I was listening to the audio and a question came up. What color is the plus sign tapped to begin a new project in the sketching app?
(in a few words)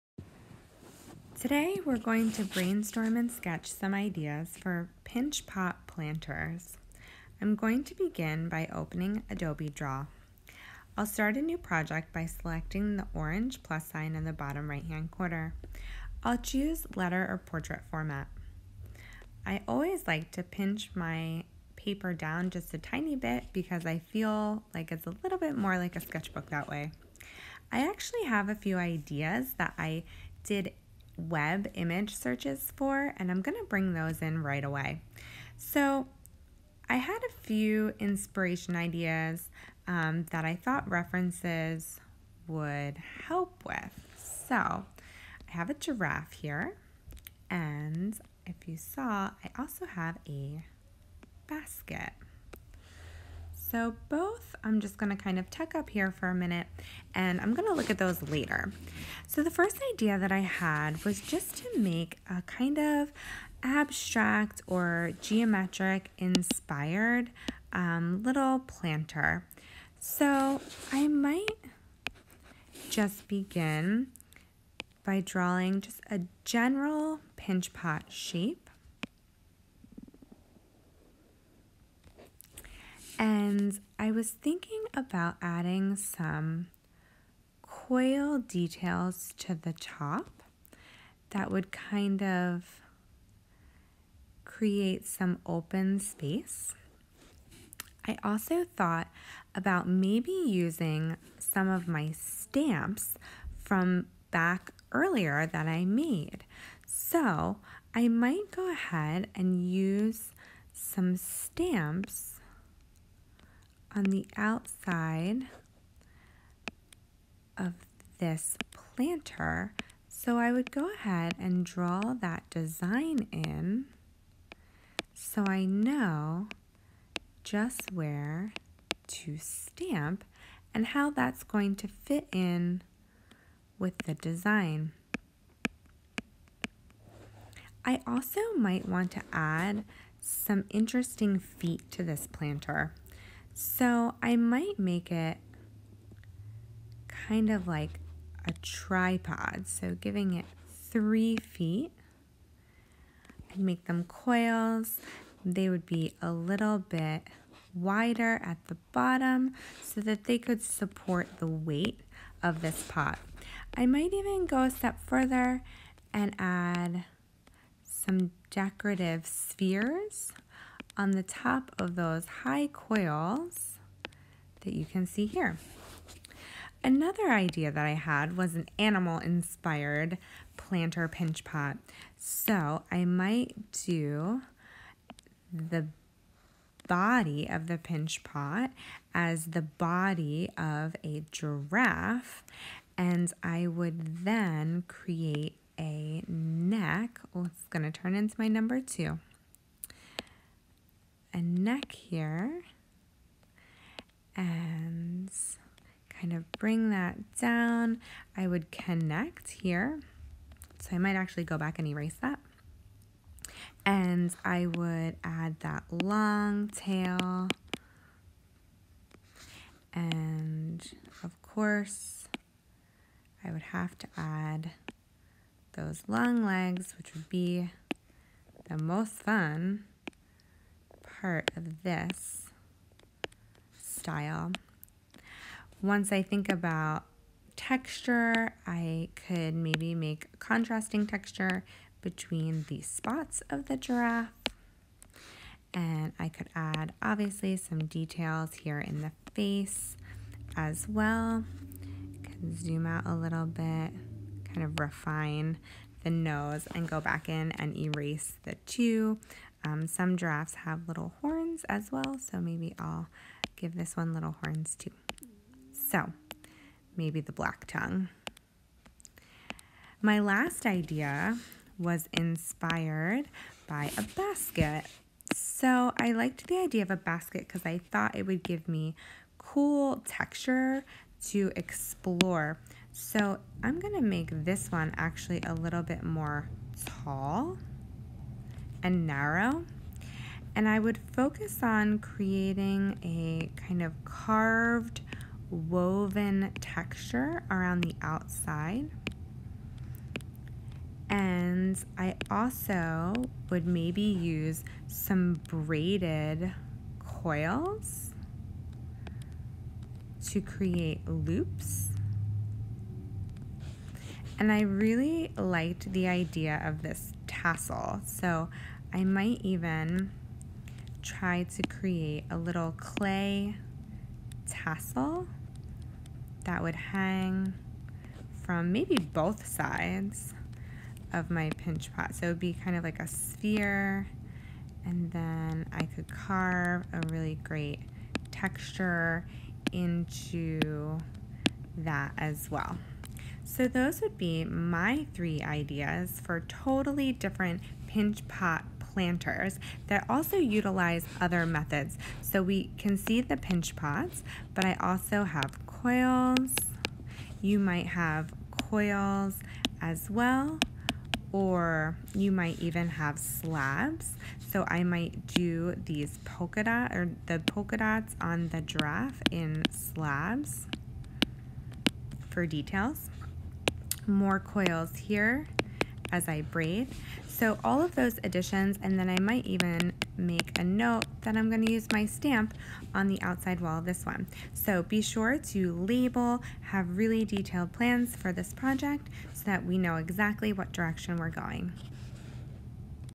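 Orange.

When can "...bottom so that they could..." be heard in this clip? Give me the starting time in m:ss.
2:38.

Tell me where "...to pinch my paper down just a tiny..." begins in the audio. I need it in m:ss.
0:20.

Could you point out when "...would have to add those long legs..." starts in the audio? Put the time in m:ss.
3:43.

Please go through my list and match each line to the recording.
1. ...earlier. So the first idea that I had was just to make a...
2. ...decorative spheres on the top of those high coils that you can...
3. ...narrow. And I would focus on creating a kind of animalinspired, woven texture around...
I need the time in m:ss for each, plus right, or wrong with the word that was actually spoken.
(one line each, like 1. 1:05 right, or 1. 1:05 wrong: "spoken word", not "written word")
1. 0:58 wrong: "later", not "earlier"
2. 2:48 right
3. 4:49 wrong: "carved", not "animalinspired".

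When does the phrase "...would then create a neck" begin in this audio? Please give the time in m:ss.
3:13.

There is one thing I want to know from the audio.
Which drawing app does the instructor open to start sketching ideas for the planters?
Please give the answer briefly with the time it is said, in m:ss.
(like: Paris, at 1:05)
Adobe Draw, at 0:09.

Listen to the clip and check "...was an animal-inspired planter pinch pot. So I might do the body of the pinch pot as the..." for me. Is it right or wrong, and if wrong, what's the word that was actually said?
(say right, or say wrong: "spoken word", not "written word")
right.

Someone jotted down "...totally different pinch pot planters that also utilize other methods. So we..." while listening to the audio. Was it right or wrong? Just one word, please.
right.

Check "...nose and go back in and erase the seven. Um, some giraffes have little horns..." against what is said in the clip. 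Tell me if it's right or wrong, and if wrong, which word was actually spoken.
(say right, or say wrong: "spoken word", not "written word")
wrong: "two", not "seven".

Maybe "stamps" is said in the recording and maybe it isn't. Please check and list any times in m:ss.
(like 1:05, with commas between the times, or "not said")
1:42, 1:51, 2:09, 6:22.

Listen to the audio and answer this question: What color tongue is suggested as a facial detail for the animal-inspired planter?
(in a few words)
Black.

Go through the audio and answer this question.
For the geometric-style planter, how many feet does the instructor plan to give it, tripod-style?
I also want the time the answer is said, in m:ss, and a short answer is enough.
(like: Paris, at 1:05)
3, at 2:30.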